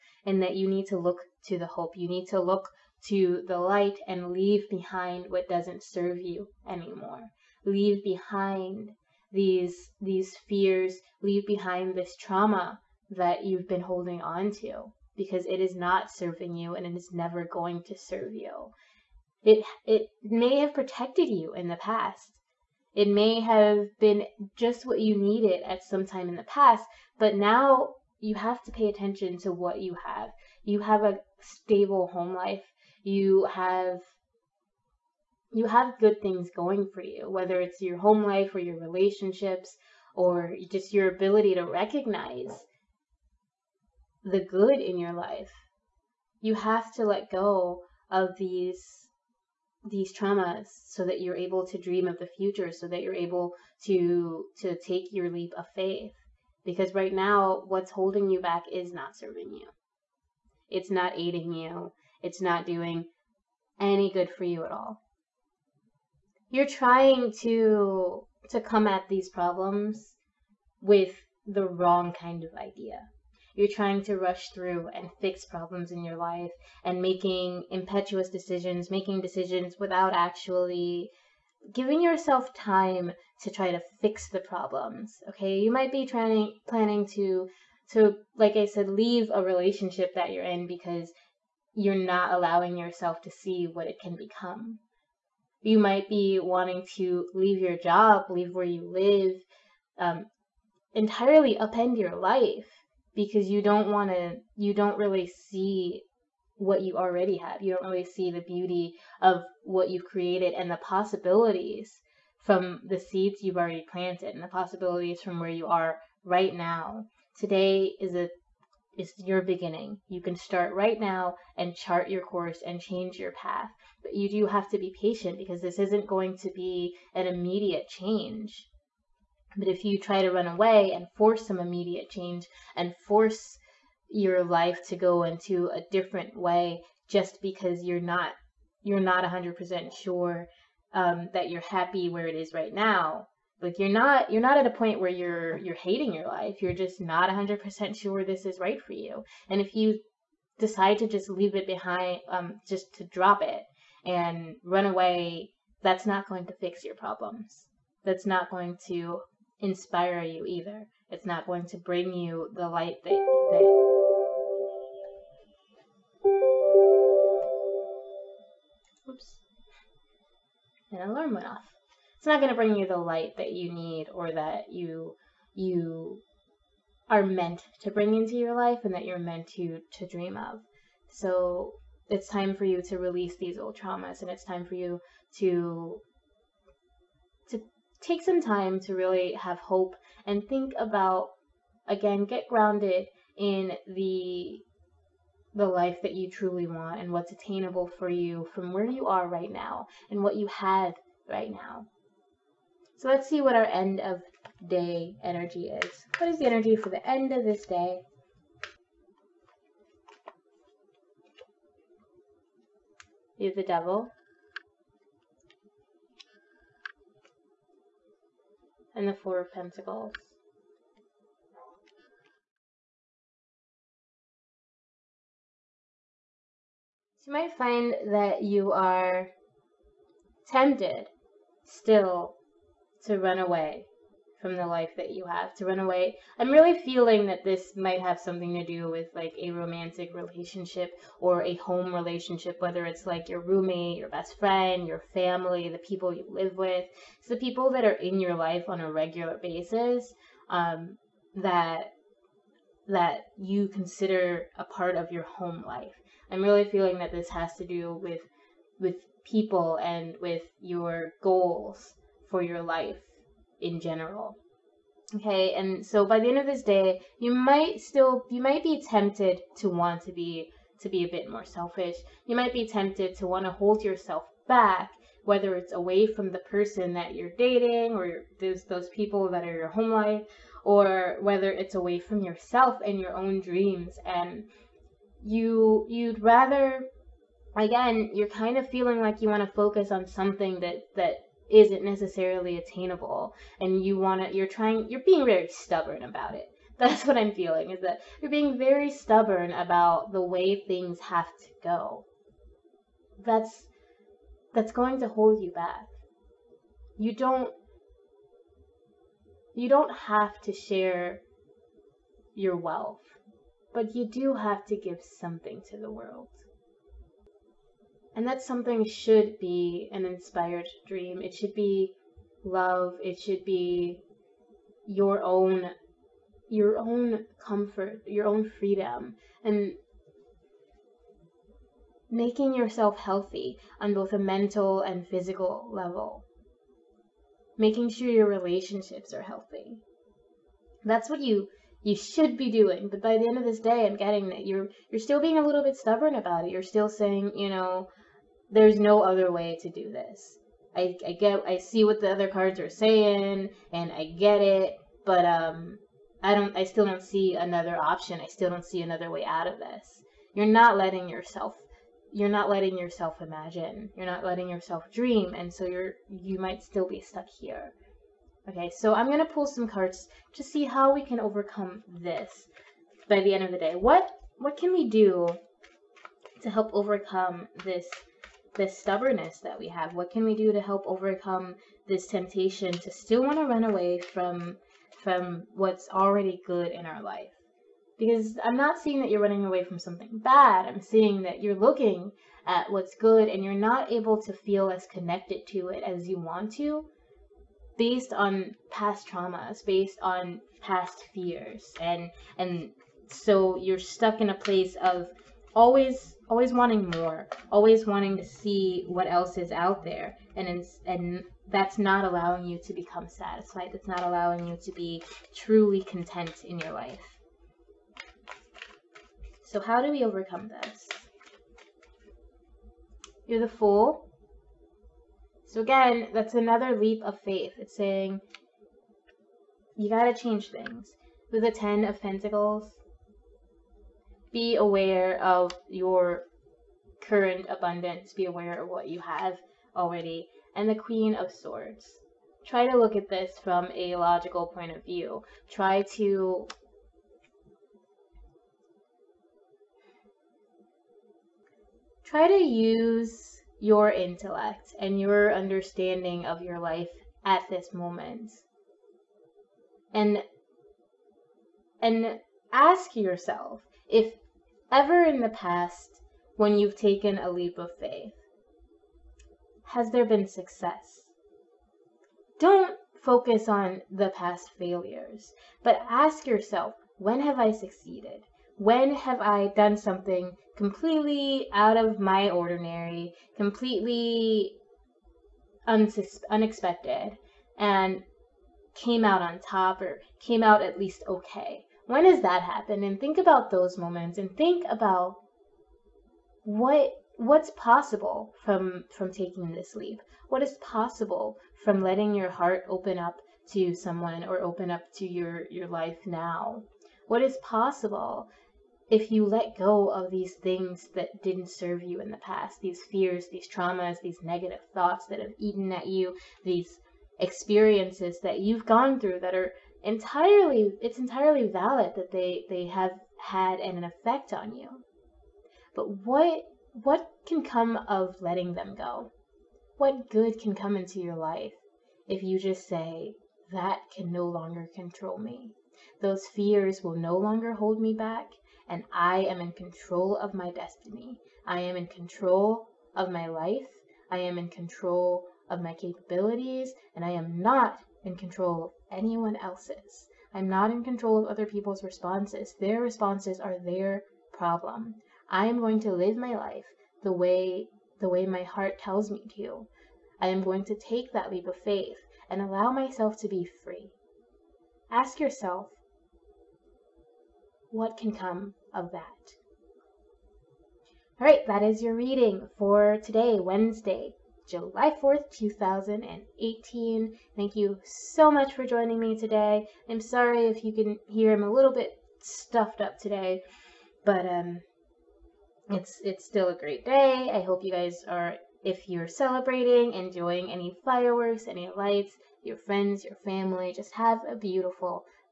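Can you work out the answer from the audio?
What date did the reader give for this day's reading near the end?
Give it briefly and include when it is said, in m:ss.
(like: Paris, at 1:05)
Wednesday, July 4th, 2018, at 9:33.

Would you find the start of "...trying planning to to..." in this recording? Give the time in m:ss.
1:26.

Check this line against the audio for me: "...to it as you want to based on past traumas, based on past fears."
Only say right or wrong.
right.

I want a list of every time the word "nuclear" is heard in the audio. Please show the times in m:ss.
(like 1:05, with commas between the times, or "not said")
not said.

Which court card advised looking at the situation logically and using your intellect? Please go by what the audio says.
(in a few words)
Queen of Swords.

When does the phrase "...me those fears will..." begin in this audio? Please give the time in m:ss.
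8:55.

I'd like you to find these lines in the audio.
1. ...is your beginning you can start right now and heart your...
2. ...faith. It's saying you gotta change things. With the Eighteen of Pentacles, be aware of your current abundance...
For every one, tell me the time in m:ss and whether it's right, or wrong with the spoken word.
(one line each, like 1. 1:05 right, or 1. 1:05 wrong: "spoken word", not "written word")
1. 1:58 wrong: "chart", not "heart"
2. 7:07 wrong: "Ten", not "Eighteen".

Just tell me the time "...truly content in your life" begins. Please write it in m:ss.
6:55.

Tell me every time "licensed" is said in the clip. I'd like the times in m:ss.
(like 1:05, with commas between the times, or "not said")
not said.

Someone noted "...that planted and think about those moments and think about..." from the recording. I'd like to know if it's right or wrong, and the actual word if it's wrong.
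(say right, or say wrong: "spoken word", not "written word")
wrong: "happened", not "planted".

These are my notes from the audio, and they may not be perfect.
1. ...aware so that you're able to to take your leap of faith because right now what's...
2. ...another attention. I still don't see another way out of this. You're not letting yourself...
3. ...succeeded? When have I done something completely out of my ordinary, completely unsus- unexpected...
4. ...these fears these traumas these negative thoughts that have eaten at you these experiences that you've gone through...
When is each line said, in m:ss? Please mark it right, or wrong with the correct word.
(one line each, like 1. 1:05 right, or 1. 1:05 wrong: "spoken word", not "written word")
1. 0:52 wrong: "future", not "aware"
2. 5:57 wrong: "option", not "attention"
3. 7:57 right
4. 8:32 right.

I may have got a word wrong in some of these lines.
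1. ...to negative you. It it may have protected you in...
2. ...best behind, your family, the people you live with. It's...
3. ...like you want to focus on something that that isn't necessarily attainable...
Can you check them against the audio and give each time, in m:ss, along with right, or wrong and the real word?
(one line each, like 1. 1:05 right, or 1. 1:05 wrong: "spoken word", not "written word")
1. 0:17 wrong: "serve", not "negative"
2. 4:04 wrong: "friend", not "behind"
3. 4:48 right.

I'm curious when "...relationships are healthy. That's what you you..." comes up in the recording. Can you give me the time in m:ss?
5:38.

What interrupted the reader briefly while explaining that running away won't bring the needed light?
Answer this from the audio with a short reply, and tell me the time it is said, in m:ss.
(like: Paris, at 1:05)
An alarm, at 2:50.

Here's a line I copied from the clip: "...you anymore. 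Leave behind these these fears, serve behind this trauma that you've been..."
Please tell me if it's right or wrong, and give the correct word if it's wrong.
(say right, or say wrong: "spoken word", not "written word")
wrong: "leave", not "serve".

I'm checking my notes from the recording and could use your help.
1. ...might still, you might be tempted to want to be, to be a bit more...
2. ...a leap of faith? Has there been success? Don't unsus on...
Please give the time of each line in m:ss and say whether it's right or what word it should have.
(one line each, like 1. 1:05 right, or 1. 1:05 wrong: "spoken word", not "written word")
1. 4:27 right
2. 7:47 wrong: "focus", not "unsus".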